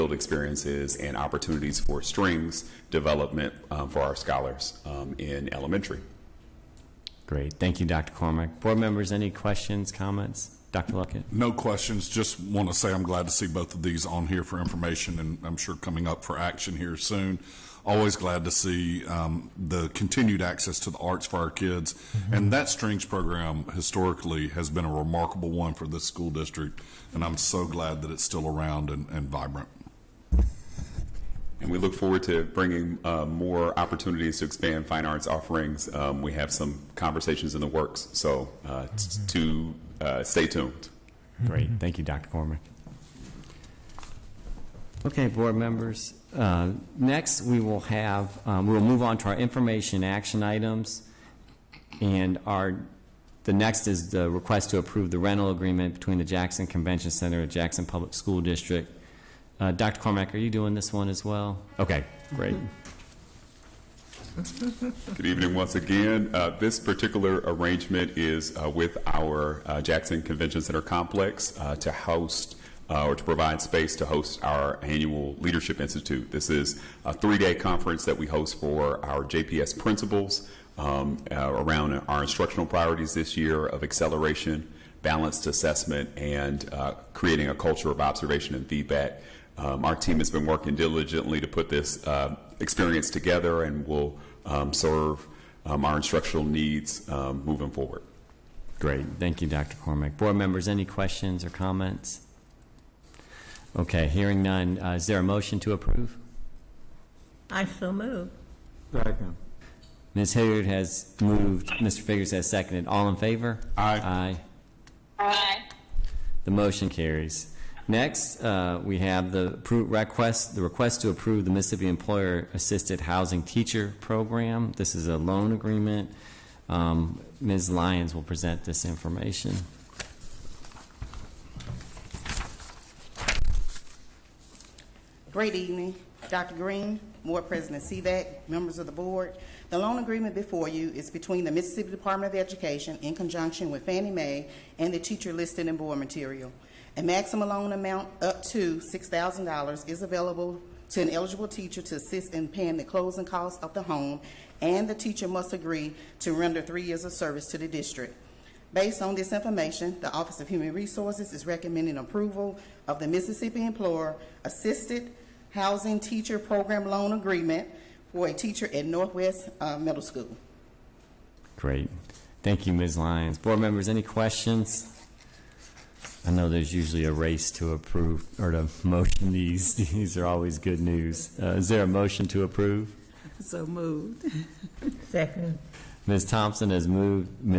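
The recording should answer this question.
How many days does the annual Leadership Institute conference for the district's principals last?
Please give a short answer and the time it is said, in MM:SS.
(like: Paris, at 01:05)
3, at 01:17.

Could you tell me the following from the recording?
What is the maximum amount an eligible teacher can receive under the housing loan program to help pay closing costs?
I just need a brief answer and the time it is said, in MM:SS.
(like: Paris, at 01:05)
$6,000, at 02:28.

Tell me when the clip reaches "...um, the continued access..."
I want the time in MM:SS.
00:19.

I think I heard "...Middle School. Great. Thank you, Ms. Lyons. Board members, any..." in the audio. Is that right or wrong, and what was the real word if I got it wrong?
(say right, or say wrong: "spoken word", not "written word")
right.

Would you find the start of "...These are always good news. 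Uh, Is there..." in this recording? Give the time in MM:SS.
02:59.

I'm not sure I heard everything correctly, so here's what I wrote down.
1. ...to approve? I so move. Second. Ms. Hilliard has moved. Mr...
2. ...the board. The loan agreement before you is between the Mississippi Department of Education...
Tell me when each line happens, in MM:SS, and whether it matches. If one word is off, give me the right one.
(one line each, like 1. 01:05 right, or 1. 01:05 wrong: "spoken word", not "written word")
1. 01:45 right
2. 02:18 right.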